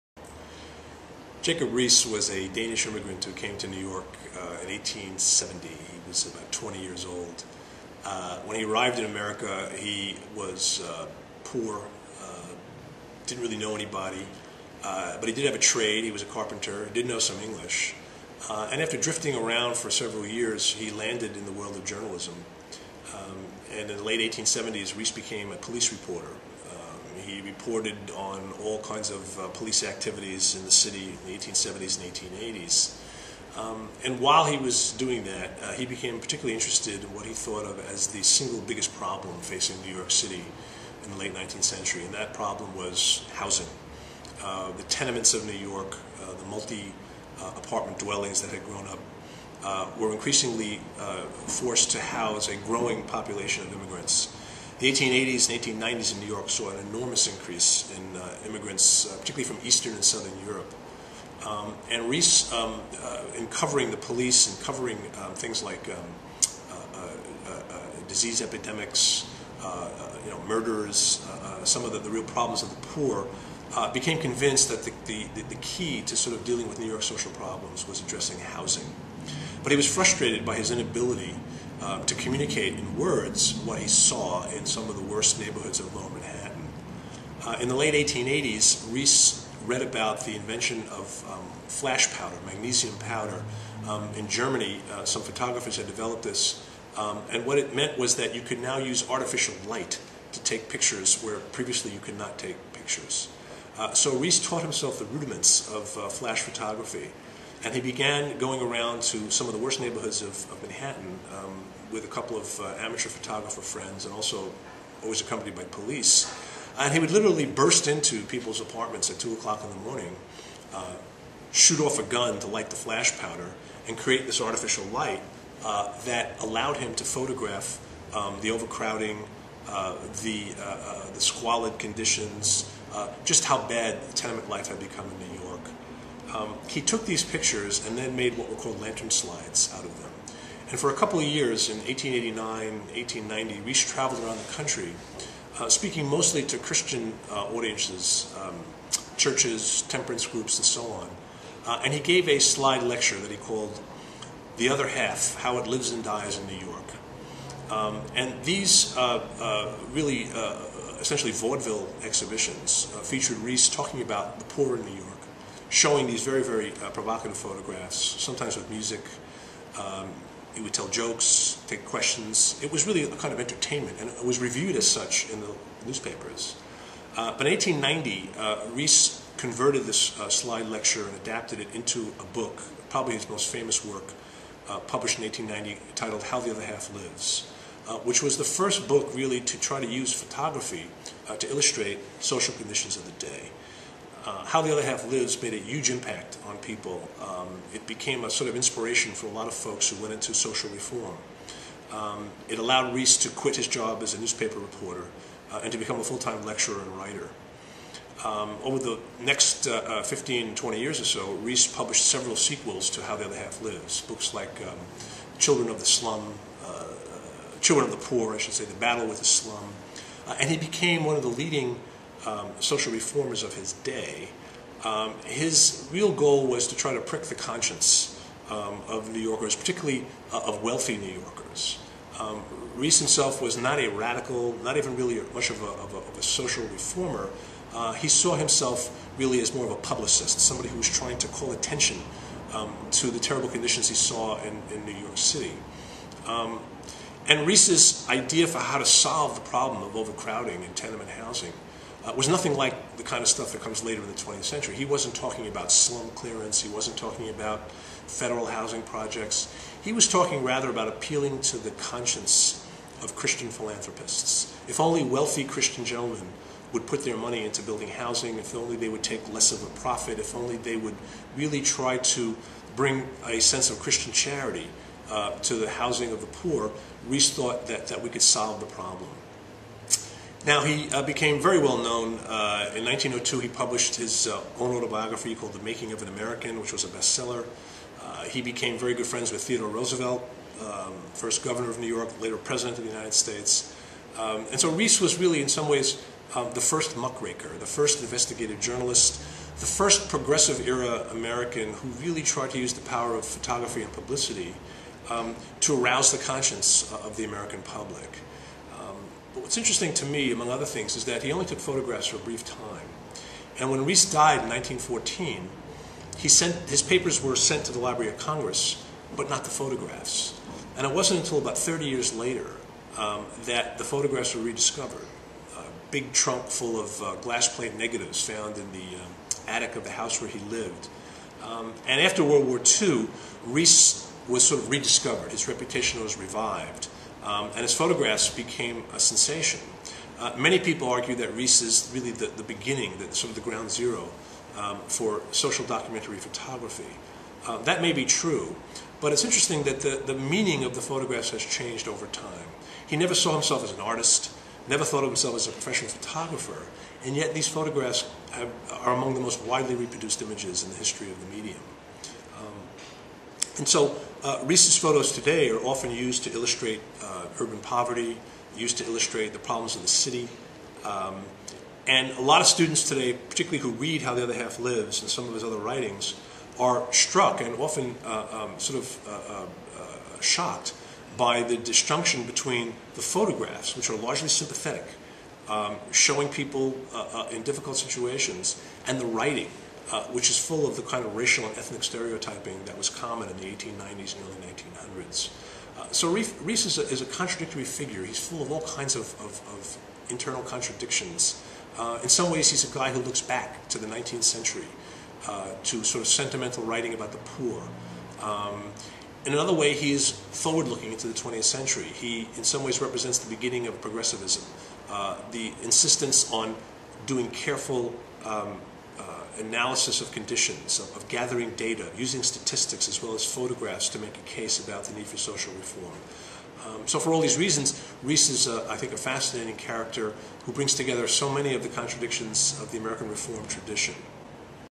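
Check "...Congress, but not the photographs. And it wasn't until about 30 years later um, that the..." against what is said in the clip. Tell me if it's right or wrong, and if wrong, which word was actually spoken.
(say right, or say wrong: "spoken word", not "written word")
right.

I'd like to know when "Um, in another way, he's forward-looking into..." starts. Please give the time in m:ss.
6:48.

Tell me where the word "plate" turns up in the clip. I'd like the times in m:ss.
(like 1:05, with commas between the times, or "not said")
5:27.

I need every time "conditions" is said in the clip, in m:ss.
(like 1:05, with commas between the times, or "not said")
2:11, 3:12, 4:03, 7:00.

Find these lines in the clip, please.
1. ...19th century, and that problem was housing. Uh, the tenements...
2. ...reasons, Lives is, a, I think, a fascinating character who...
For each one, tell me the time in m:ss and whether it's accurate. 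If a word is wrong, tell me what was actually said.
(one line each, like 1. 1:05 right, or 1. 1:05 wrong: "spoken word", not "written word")
1. 0:41 right
2. 7:07 wrong: "Riis", not "Lives".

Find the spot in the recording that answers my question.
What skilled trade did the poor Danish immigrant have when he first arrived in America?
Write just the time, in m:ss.
0:16.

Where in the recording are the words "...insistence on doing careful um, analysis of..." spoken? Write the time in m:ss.
6:55.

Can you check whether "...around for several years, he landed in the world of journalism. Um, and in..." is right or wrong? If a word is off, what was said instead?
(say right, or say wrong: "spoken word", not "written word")
right.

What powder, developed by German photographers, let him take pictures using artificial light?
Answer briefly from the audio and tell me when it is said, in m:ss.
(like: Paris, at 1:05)
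Magnesium powder, at 1:32.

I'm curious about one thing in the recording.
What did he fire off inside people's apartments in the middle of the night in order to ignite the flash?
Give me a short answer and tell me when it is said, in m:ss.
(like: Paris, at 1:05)
A gun, at 2:01.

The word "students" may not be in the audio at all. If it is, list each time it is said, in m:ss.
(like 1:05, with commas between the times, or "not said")
6:12.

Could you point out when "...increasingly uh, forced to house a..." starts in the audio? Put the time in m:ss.
0:50.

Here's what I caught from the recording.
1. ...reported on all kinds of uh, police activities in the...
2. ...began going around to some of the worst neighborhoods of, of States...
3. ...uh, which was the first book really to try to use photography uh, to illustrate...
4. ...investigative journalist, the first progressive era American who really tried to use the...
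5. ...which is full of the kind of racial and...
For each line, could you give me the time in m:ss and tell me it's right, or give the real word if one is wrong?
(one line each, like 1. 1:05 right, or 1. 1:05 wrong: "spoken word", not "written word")
1. 0:27 right
2. 1:47 wrong: "Manhattan", not "States"
3. 3:07 right
4. 4:58 right
5. 6:30 right.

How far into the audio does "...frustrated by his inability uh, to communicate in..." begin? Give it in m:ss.
1:19.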